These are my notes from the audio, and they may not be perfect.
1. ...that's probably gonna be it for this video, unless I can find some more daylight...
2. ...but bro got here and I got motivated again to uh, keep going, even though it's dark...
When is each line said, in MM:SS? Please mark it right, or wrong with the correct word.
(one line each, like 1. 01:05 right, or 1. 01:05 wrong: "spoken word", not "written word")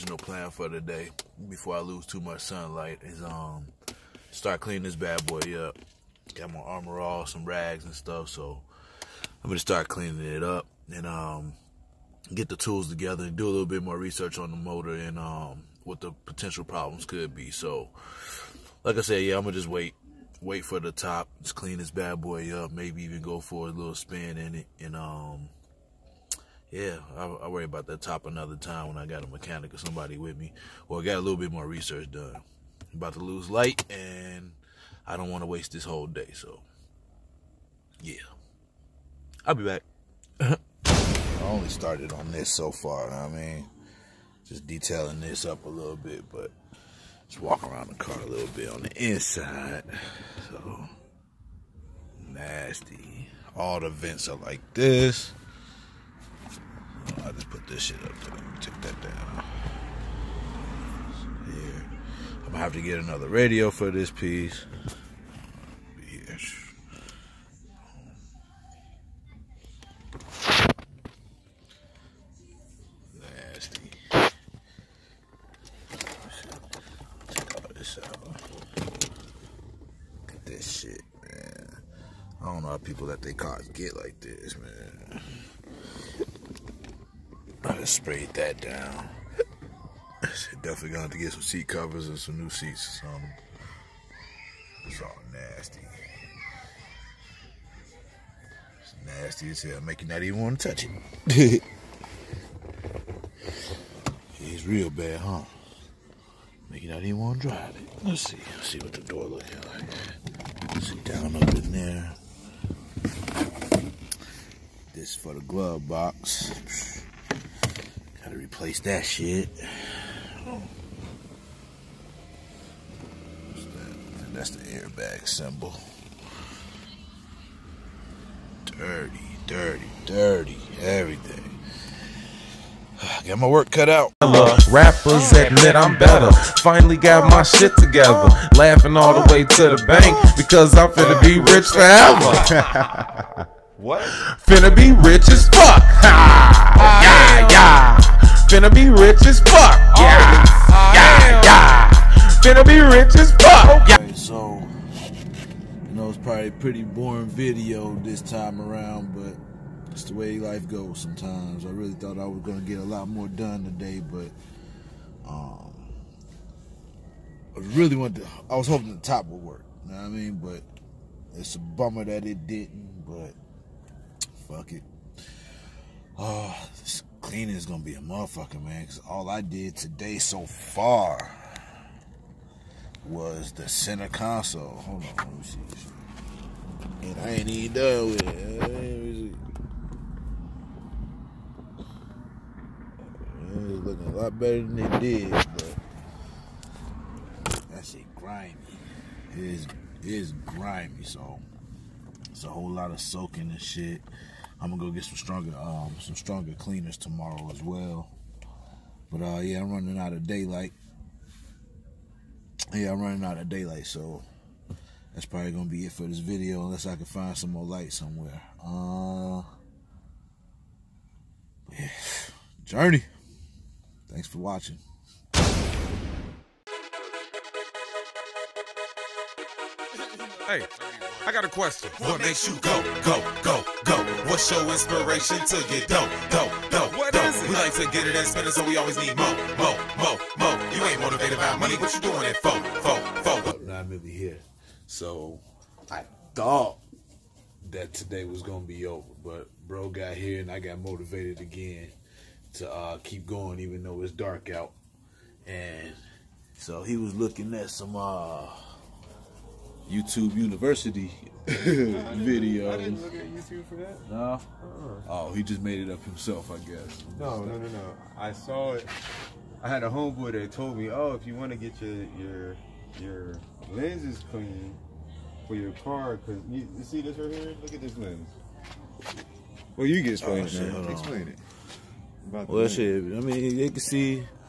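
1. 03:35 wrong: "light", not "daylight"
2. 04:09 right.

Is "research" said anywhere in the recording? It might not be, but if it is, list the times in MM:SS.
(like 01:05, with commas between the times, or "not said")
00:13, 00:31.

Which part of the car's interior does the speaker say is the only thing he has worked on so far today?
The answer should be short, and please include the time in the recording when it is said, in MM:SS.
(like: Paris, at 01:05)
The center console, at 03:03.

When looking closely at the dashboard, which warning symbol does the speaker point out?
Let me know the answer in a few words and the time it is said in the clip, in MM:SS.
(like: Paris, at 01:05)
Airbag symbol, at 02:04.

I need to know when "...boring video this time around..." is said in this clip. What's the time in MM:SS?
02:36.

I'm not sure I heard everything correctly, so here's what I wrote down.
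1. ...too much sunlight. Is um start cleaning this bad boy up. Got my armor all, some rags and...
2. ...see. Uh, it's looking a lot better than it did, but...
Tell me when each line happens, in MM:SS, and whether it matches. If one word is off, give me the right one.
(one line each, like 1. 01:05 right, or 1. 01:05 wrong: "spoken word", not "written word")
1. 00:02 right
2. 03:11 right.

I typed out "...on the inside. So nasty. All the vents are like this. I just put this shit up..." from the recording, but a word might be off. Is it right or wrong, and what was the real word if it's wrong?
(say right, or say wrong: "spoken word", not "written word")
right.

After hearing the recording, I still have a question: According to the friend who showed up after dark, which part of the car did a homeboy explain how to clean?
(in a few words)
Lenses.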